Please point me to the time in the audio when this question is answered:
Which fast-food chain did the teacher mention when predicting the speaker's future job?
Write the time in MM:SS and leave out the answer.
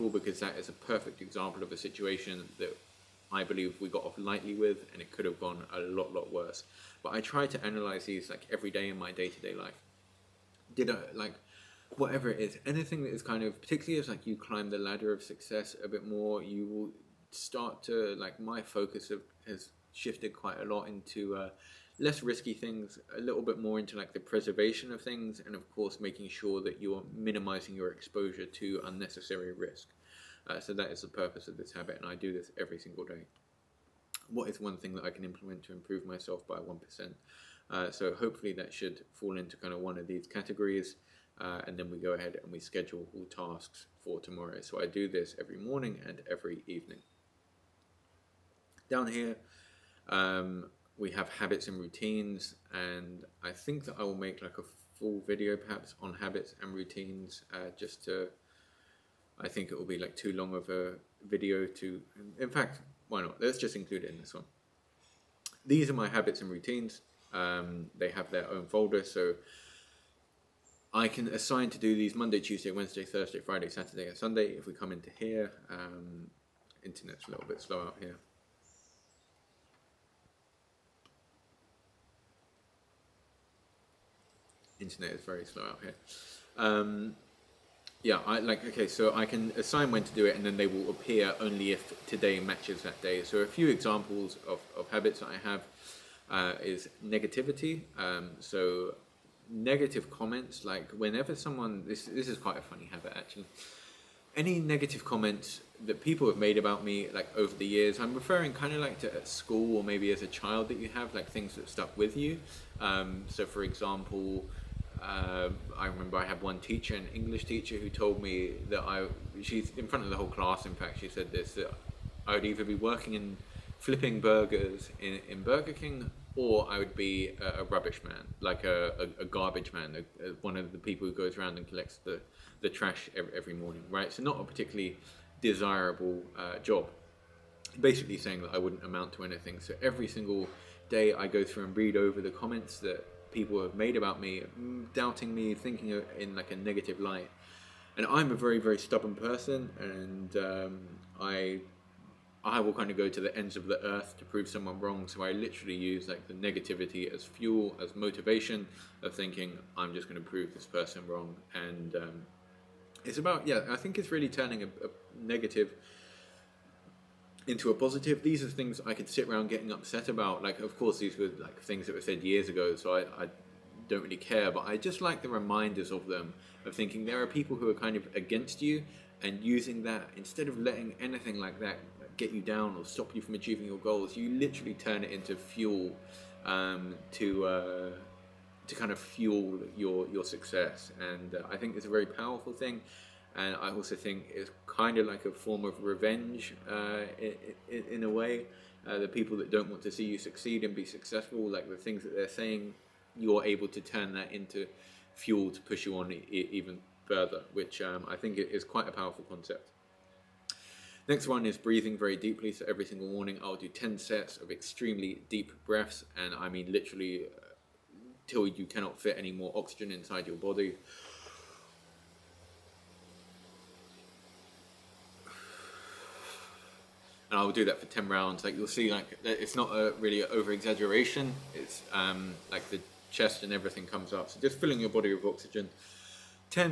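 02:05.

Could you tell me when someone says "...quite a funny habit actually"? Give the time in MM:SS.
01:42.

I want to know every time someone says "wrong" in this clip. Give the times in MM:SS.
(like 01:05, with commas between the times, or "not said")
02:34, 02:41.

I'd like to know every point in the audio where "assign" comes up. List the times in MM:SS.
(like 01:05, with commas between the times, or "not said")
01:11, 01:29.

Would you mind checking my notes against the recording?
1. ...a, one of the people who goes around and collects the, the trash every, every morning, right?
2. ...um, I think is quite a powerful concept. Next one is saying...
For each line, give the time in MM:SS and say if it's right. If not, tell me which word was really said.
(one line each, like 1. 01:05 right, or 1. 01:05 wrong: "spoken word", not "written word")
1. 02:10 right
2. 03:27 wrong: "breathing", not "saying".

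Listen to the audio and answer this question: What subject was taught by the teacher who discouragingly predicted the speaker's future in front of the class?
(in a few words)
English.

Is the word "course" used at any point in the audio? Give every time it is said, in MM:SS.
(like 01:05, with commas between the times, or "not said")
00:25, 02:50.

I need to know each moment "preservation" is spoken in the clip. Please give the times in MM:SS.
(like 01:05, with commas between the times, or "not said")
00:24.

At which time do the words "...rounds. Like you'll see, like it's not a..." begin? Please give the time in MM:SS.
03:48.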